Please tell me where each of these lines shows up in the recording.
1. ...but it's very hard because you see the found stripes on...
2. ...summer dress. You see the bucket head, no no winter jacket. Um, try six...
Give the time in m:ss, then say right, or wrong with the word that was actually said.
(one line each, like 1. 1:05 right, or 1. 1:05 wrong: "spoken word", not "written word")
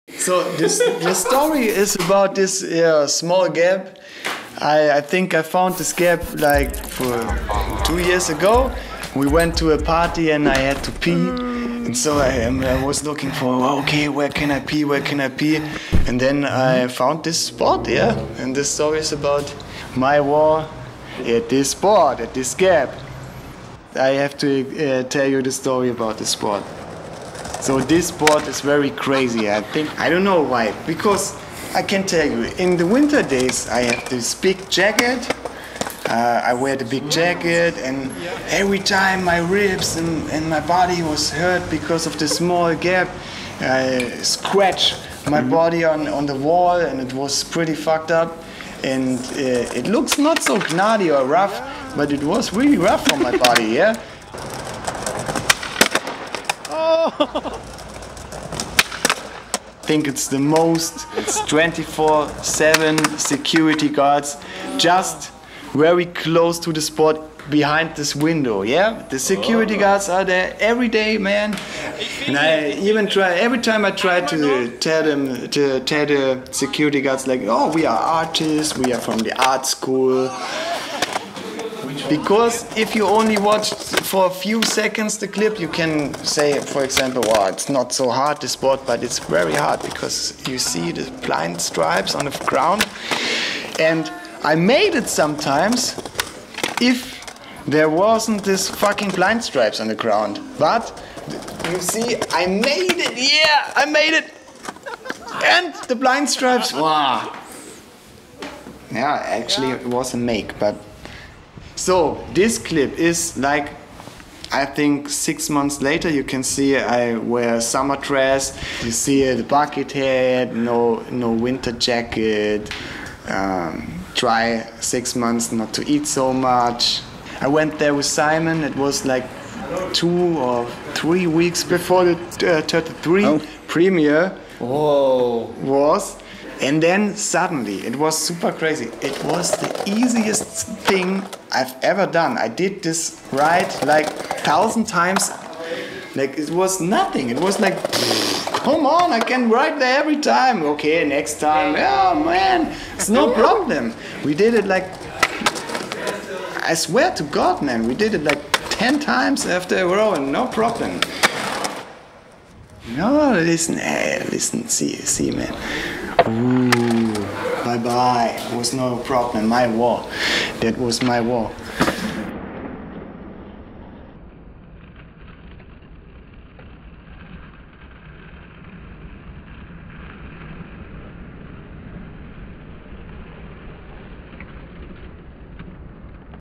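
1. 1:28 wrong: "blind", not "found"
2. 1:57 right.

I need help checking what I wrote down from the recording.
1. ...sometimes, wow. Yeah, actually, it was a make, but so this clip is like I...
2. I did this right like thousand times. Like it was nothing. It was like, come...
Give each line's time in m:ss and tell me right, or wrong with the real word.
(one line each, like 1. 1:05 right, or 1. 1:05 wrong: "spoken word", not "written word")
1. 1:46 wrong: "stripes", not "sometimes"
2. 2:22 right.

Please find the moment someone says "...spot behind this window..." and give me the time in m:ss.
1:06.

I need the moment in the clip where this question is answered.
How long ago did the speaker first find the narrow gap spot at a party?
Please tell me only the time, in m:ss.
0:07.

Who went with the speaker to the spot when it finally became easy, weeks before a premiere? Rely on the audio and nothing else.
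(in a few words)
Simon.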